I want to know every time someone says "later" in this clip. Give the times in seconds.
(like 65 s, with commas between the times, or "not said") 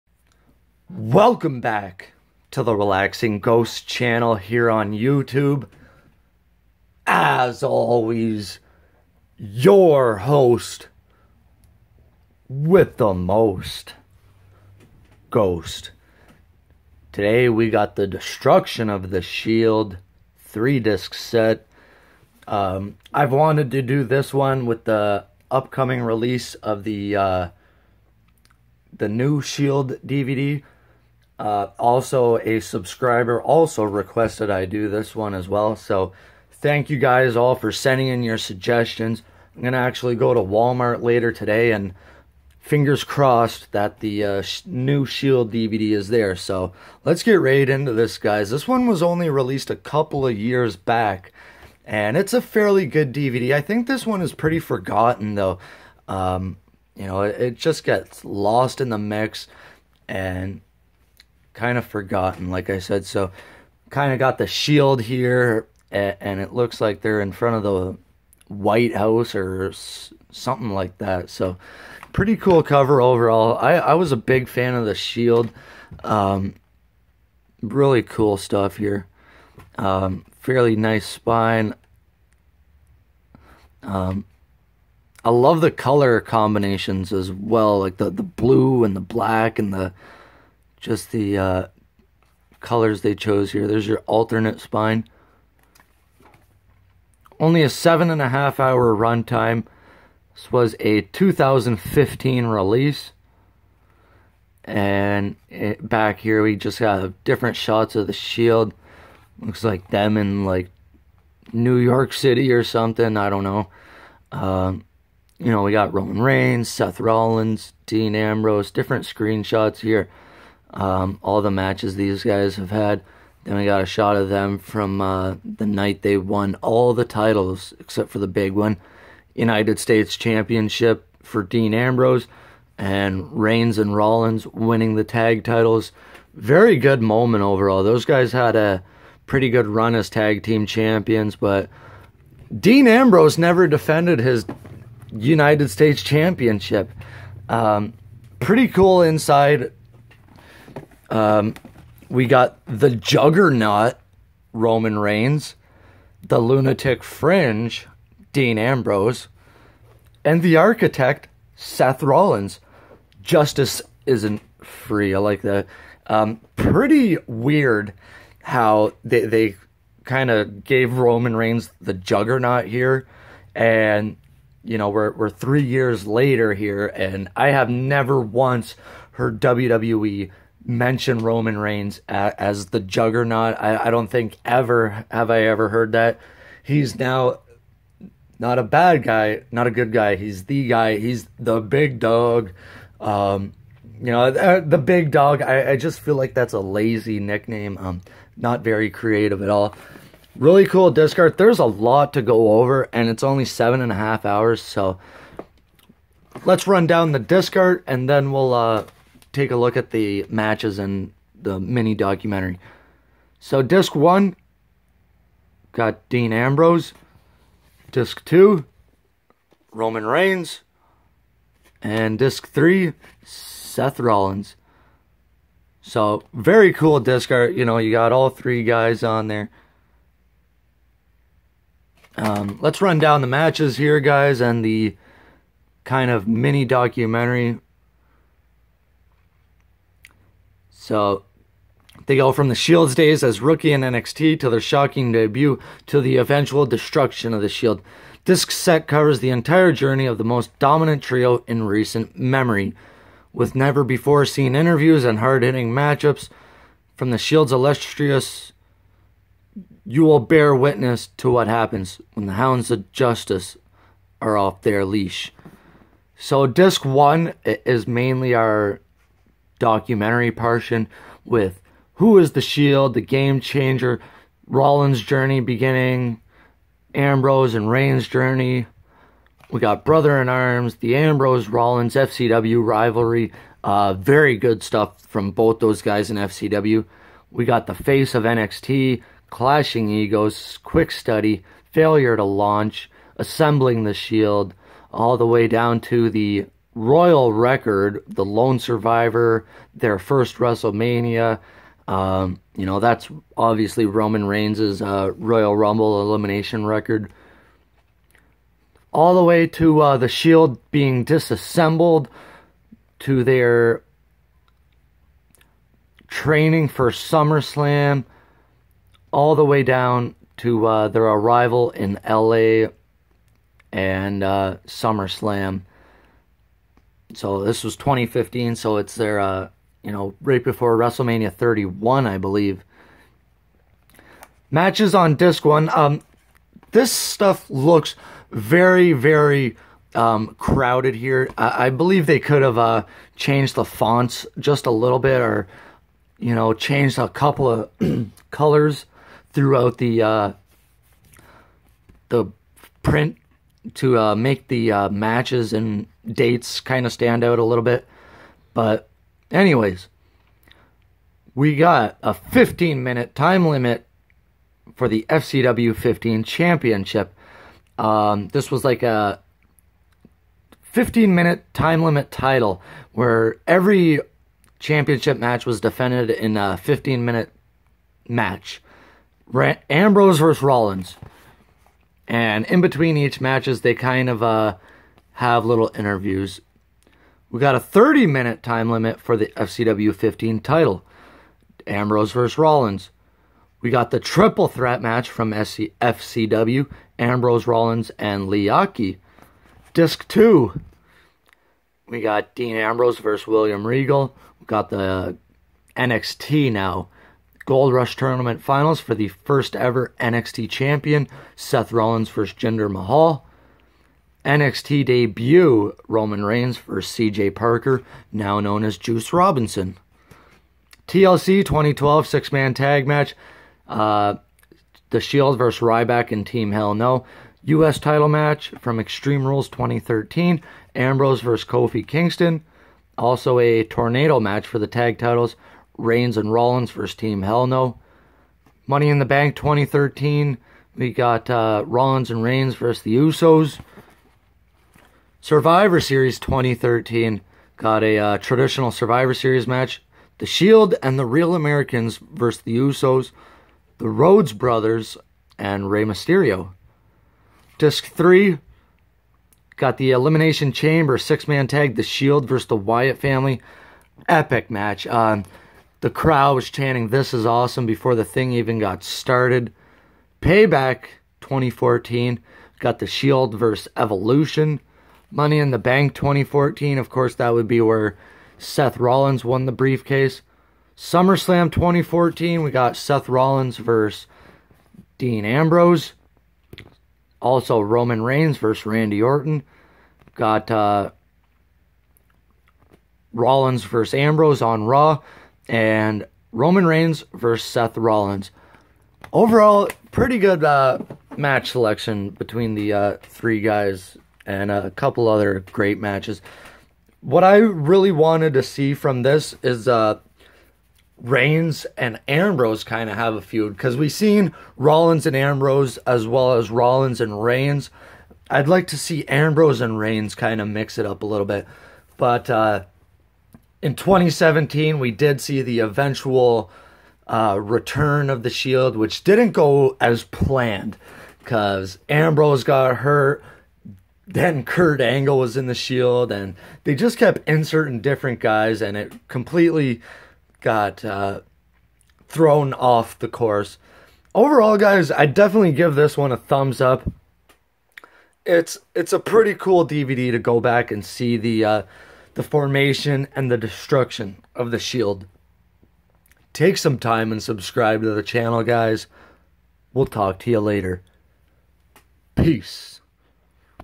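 41 s, 176 s, 560 s.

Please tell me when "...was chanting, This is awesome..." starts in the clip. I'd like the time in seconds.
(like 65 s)
466 s.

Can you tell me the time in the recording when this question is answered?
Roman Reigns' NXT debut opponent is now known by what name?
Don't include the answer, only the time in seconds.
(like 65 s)
418 s.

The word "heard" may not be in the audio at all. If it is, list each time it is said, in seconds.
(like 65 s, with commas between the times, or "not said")
179 s, 185 s.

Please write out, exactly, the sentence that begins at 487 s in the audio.
Also, Roman Reigns versus Randy Orton.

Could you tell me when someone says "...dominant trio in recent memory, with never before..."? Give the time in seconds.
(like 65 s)
250 s.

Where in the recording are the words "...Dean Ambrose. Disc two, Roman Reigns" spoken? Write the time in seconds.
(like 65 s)
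216 s.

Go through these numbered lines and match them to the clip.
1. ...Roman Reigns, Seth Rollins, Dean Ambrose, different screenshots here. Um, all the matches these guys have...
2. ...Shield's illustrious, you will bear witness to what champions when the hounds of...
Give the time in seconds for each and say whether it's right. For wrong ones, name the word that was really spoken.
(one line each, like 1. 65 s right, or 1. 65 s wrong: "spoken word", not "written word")
1. 115 s right
2. 257 s wrong: "happens", not "champions".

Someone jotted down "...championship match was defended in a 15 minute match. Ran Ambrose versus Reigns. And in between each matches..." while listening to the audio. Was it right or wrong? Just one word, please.
wrong.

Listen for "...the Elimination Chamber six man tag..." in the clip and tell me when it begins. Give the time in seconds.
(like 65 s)
459 s.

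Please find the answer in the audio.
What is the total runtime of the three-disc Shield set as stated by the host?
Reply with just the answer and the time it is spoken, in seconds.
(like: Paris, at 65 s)
seven and a half hours, at 97 s.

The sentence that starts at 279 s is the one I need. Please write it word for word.
We got Brother in Arms, the Ambrose Rollins FCW rivalry.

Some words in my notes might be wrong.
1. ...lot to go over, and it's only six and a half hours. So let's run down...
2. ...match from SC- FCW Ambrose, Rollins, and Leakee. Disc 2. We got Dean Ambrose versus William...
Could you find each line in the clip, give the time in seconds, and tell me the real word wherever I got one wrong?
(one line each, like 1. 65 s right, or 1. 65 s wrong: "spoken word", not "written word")
1. 201 s wrong: "seven", not "six"
2. 394 s right.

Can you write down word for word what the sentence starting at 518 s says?
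I'd like to see Ambrose and Reigns kind of mix it up a little bit.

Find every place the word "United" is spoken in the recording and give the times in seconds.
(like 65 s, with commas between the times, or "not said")
129 s, 145 s.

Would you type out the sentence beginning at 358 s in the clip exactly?
But, anyways, we got a 15 minute time limit for the FCW 15 championship.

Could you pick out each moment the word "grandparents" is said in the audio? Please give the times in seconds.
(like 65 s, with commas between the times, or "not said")
not said.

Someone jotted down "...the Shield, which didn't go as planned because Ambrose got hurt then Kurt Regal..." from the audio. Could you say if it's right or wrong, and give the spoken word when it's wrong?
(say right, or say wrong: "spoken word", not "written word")
wrong: "Angle", not "Regal".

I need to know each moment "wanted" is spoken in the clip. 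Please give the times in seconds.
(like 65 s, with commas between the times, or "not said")
23 s, 507 s.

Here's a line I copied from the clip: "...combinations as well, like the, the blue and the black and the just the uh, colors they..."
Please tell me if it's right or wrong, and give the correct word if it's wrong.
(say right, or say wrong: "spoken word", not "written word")
right.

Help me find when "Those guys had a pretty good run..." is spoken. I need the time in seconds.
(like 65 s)
137 s.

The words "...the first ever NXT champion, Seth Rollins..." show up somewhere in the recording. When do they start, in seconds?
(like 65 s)
408 s.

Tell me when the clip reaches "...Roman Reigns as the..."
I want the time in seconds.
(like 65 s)
181 s.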